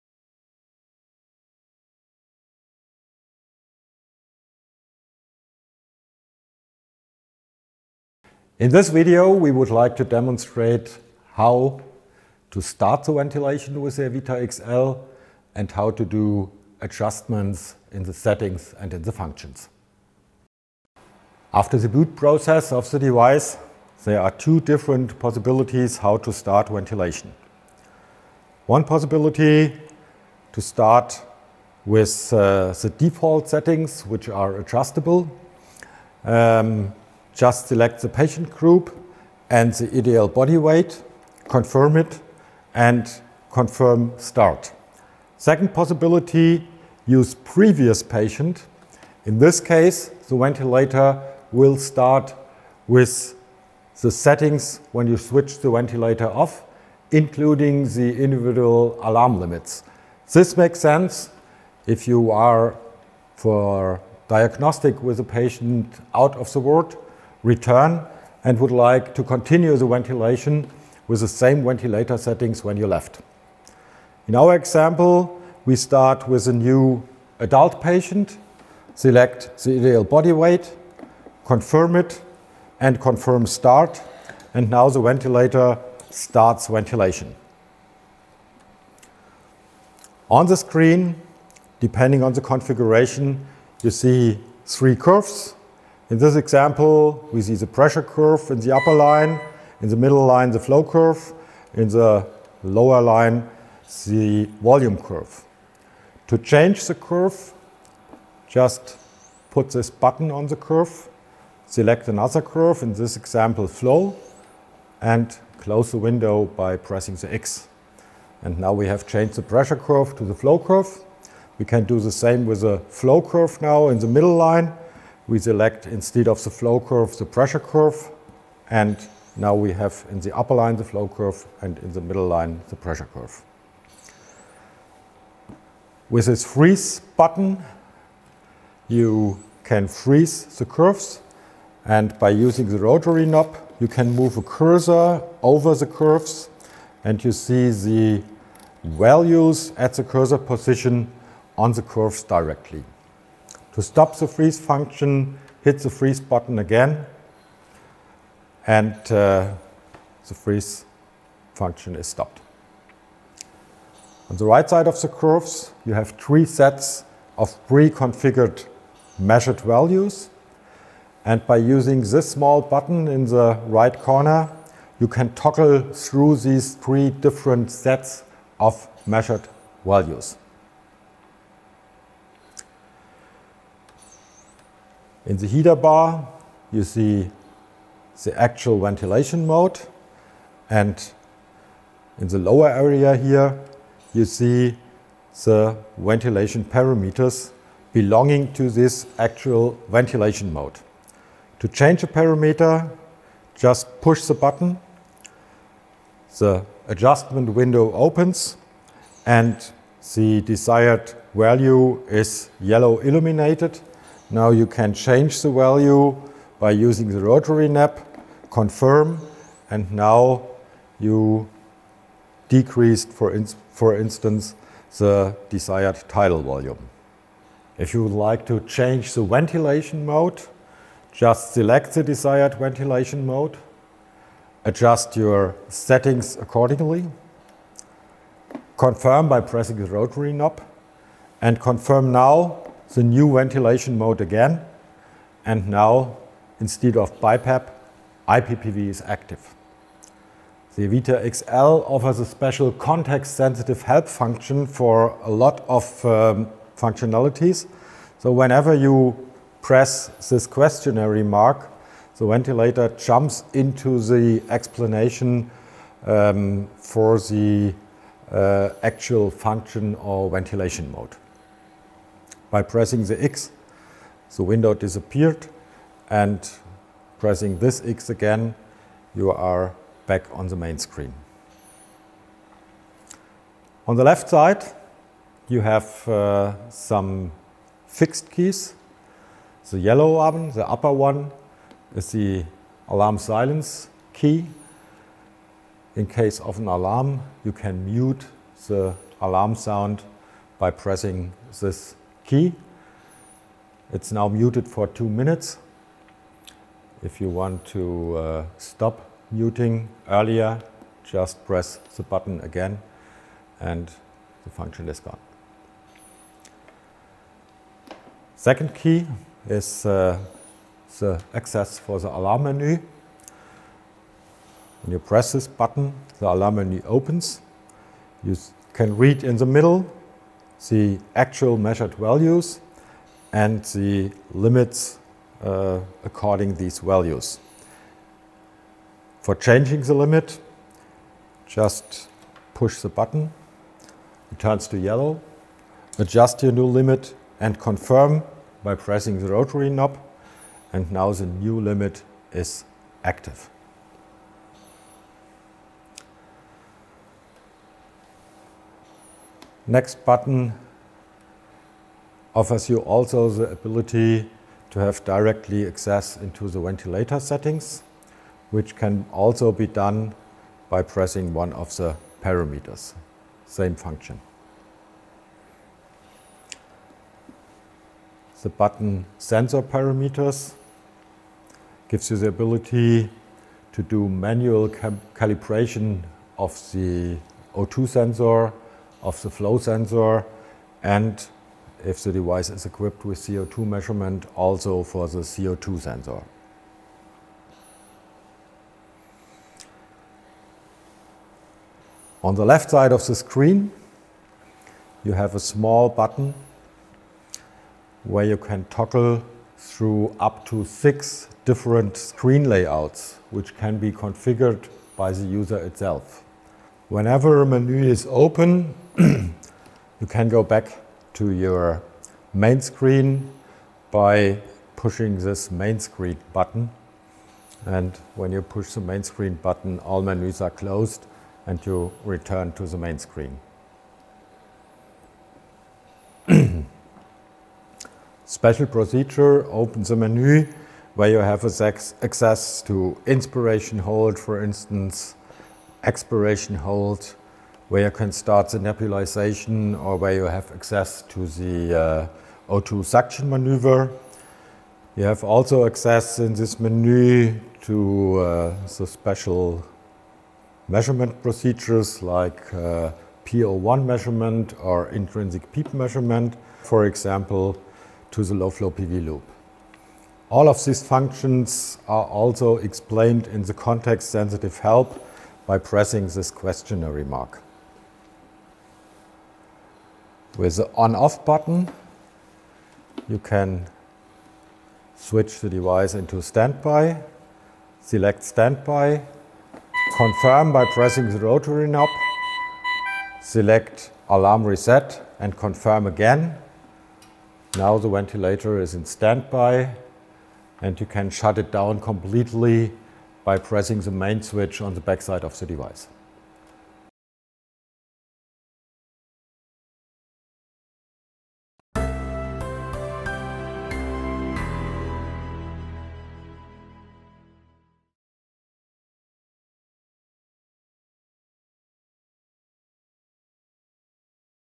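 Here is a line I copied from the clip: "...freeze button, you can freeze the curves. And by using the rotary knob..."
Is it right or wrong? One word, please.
right.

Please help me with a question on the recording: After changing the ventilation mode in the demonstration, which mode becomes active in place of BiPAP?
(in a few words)
IPPV.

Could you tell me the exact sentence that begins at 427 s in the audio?
And when you push the main screen button, all menus are closed and you return to the main screen.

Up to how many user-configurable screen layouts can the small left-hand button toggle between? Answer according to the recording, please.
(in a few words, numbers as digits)
6.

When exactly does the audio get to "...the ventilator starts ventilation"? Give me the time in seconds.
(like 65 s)
84 s.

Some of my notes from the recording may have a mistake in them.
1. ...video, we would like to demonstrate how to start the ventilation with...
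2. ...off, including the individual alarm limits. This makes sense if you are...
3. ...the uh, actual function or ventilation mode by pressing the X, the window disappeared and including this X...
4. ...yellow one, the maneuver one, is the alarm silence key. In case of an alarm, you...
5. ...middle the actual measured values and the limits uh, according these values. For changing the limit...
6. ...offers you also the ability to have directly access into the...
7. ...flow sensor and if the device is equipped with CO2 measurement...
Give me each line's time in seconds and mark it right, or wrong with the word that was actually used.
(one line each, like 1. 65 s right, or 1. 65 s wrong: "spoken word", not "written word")
1. 8 s right
2. 56 s right
3. 267 s wrong: "pressing", not "including"
4. 289 s wrong: "upper", not "maneuver"
5. 329 s right
6. 362 s right
7. 389 s right.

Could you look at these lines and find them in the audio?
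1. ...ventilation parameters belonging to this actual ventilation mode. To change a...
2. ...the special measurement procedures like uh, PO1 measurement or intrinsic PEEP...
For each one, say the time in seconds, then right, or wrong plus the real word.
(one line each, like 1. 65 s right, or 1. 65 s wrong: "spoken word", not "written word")
1. 195 s right
2. 458 s right.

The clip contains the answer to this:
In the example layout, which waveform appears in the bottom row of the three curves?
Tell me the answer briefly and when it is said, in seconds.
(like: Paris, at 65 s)
volume curve, at 104 s.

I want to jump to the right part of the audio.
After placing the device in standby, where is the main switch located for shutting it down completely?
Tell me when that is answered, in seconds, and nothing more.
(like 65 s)
504 s.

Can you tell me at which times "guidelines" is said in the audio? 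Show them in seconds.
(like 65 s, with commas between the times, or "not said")
not said.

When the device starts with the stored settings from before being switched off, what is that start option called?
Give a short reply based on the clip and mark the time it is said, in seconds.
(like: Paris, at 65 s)
use previous patient, at 47 s.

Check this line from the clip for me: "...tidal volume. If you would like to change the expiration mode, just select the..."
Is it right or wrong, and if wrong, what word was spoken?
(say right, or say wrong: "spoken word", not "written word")
wrong: "ventilation", not "expiration".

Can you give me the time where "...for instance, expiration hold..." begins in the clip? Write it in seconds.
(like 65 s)
444 s.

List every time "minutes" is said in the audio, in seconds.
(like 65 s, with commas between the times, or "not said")
305 s.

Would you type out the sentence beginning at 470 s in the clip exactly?
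All of these functions are also explained in the context sensitive help by pressing this questionnaire mark.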